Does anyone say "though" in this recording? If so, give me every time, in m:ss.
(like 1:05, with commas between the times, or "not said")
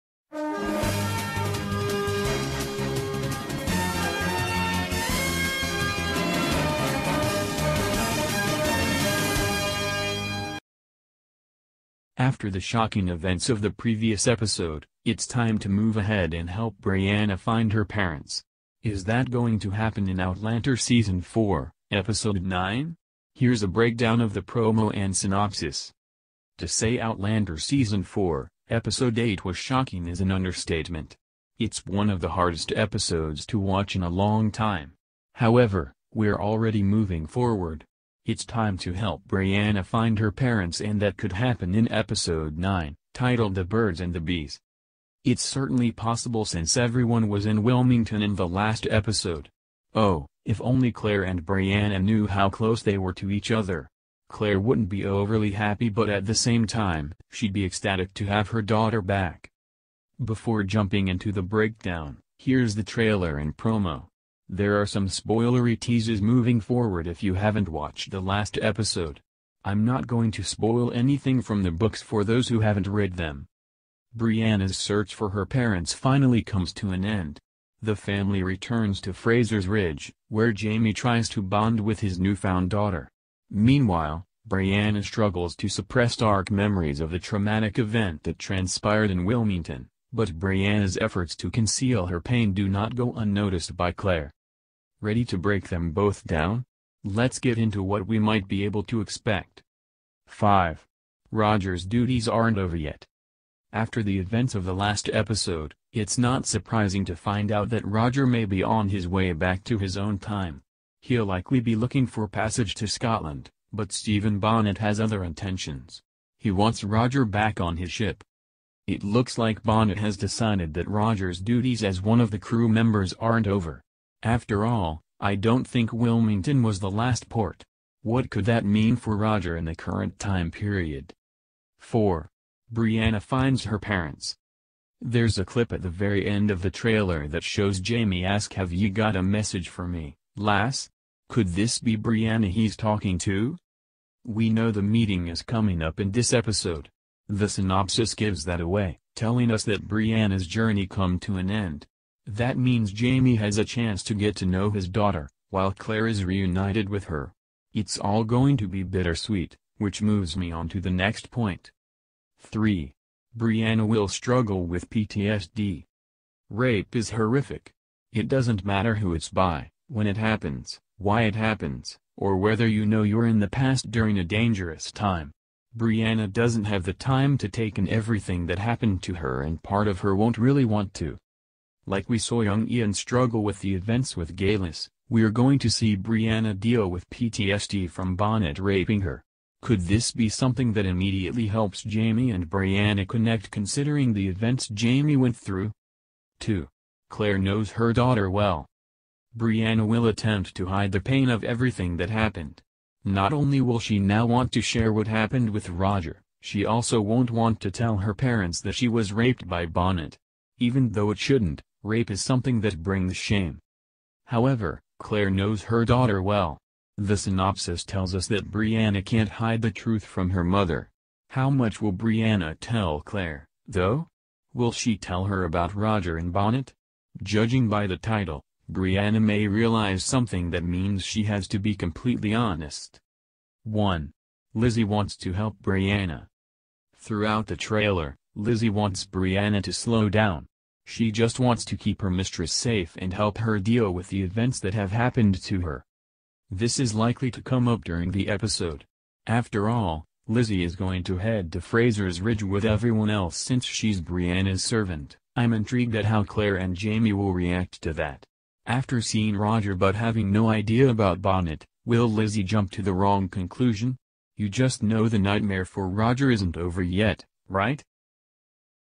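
3:30, 3:43.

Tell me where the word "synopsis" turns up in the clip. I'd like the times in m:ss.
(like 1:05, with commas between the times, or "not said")
0:25, 2:27, 3:37.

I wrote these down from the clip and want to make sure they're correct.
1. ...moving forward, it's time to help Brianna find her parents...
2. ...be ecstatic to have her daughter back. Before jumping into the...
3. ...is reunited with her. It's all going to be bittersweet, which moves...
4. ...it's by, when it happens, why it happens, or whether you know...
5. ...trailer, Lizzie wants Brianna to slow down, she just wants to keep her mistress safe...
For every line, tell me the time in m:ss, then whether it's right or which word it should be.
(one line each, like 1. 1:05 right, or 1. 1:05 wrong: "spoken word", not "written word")
1. 0:36 right
2. 0:57 right
3. 2:36 right
4. 2:49 right
5. 3:57 right.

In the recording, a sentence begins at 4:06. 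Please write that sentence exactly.
This is likely to come up during the episode.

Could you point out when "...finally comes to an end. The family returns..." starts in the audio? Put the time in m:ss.
1:15.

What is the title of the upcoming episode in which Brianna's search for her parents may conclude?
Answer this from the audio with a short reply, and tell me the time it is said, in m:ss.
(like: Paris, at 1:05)
The Birds and the Bees, at 0:43.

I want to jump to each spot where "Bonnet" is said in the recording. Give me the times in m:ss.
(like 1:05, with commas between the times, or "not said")
1:54, 1:59, 3:08, 3:29, 3:46, 4:21.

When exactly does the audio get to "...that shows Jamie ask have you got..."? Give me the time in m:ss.
2:17.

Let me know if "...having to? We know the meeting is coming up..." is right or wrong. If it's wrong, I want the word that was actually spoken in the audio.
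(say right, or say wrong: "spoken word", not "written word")
wrong: "talking", not "having".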